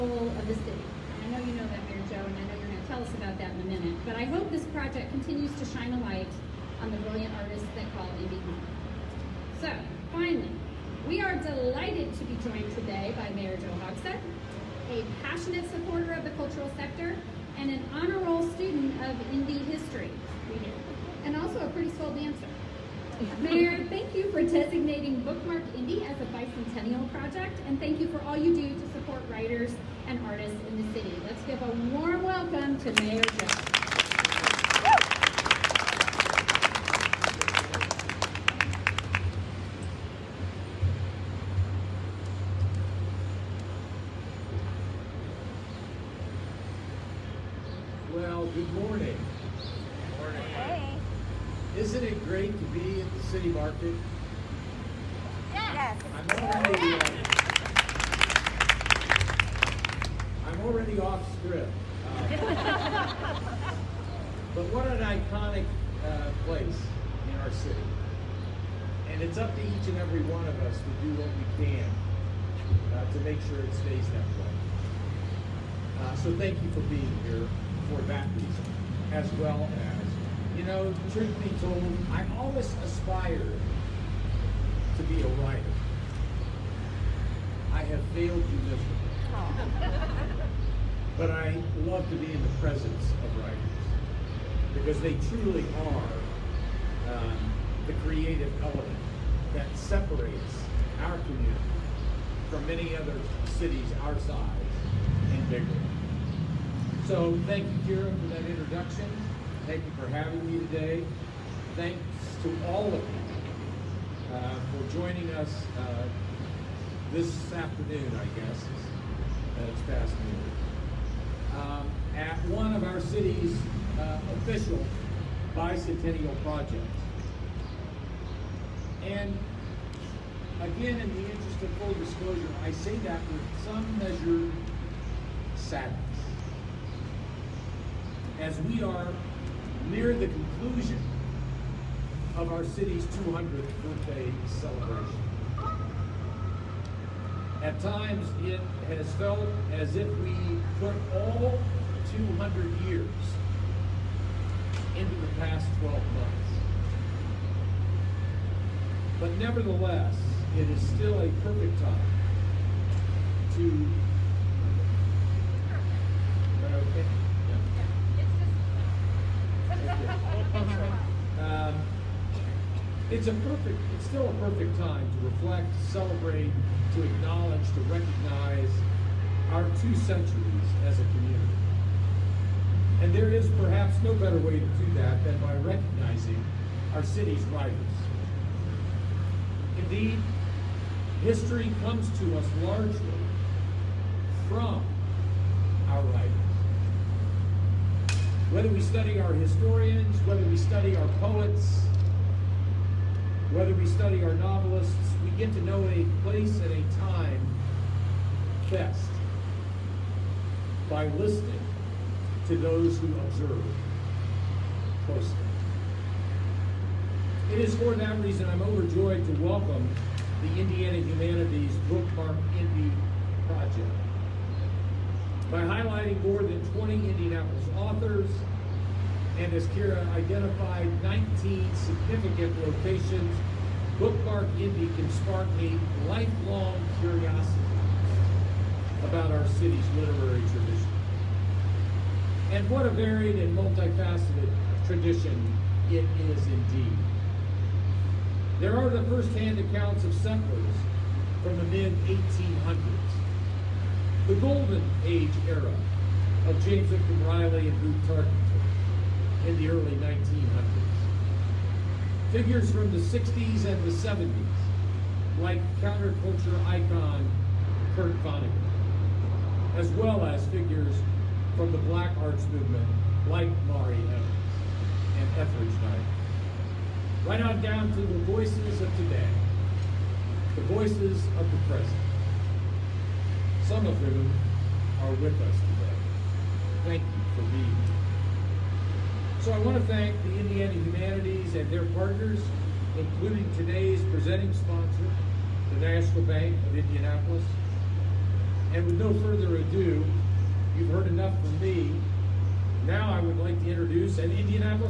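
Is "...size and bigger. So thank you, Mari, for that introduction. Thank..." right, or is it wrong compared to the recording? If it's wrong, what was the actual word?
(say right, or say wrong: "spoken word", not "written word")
wrong: "Keira", not "Mari".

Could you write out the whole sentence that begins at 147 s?
At times, it has felt as if we put all 200 years into the past 12 months.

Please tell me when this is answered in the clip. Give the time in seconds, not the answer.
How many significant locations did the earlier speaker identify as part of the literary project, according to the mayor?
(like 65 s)
231 s.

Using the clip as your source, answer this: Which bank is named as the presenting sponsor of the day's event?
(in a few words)
National Bank of Indianapolis.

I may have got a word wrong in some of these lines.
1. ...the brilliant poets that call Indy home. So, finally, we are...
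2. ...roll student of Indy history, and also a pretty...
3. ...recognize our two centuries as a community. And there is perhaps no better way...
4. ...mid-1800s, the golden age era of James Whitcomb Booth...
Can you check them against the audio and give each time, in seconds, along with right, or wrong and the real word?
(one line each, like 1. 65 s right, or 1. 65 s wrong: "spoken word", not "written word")
1. 6 s wrong: "artists", not "poets"
2. 18 s right
3. 177 s right
4. 251 s wrong: "Riley", not "Booth".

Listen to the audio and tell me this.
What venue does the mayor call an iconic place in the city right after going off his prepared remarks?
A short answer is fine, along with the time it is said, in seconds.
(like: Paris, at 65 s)
City Market, at 53 s.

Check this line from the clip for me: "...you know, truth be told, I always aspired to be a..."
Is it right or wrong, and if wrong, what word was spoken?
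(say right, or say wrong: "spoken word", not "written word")
right.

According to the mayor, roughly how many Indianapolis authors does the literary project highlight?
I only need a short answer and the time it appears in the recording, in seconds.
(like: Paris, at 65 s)
More than 20, at 226 s.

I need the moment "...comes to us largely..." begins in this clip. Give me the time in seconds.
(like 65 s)
191 s.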